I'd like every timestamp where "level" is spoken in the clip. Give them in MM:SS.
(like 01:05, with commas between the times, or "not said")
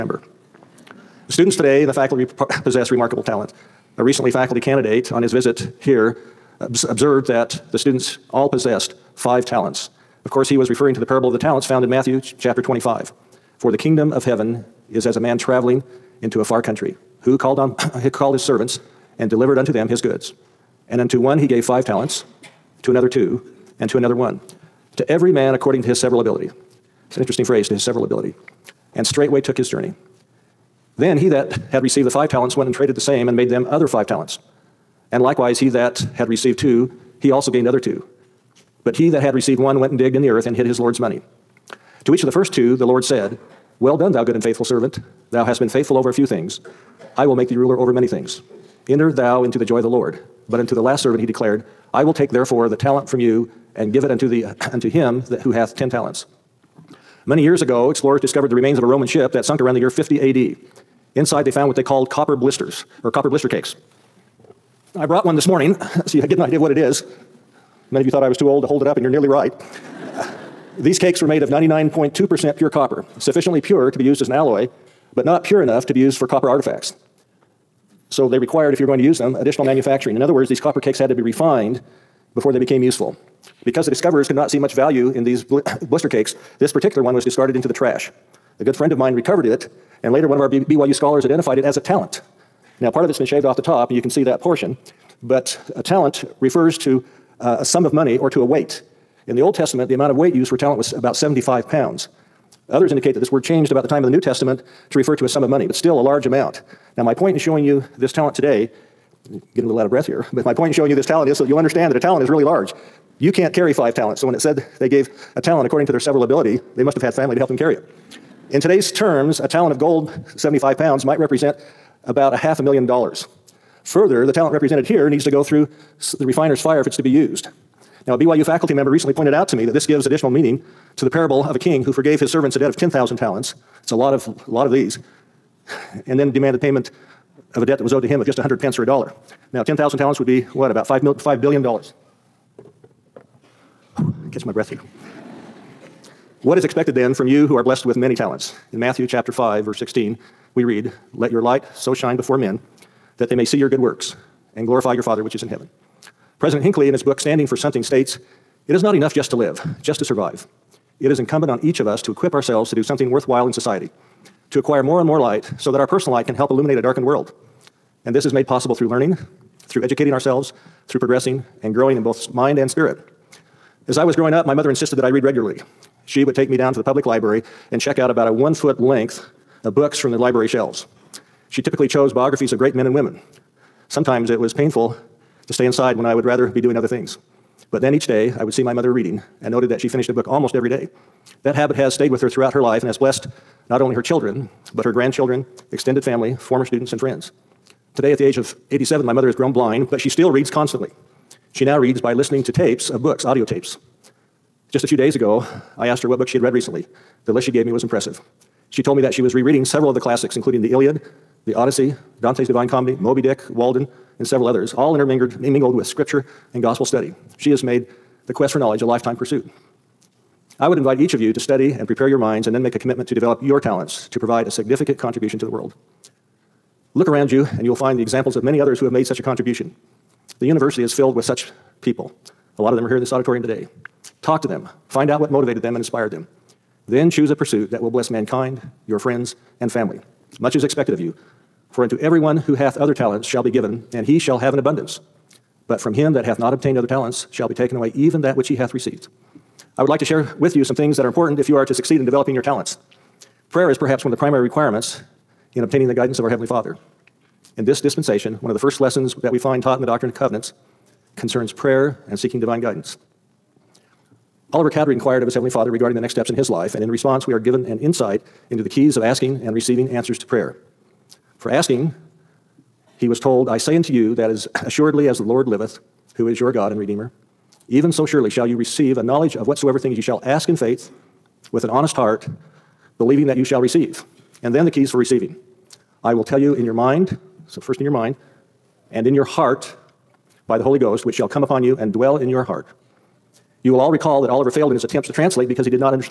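not said.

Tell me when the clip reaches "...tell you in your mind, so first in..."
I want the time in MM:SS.
04:46.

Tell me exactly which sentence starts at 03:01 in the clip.
She typically chose biographies of great men and women.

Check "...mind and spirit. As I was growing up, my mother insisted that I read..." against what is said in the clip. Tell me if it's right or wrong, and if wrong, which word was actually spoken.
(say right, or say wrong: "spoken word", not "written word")
right.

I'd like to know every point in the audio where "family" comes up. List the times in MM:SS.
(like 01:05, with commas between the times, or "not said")
01:57, 03:16, 03:59.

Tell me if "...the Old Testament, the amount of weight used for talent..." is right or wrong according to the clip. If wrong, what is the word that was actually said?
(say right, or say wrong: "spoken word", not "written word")
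right.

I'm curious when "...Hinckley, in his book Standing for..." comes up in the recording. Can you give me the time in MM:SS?
02:36.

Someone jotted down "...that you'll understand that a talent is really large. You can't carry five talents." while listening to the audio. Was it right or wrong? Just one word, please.
right.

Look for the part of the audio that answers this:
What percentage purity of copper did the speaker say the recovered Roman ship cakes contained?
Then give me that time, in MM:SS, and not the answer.
01:11.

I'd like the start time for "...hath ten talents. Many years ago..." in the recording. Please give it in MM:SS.
00:55.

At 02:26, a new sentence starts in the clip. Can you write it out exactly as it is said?
what is expected then from you who are blessed with many talents?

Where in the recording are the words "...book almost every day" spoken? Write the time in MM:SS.
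03:10.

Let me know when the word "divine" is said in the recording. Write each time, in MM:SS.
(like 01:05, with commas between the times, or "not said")
03:32, 04:22.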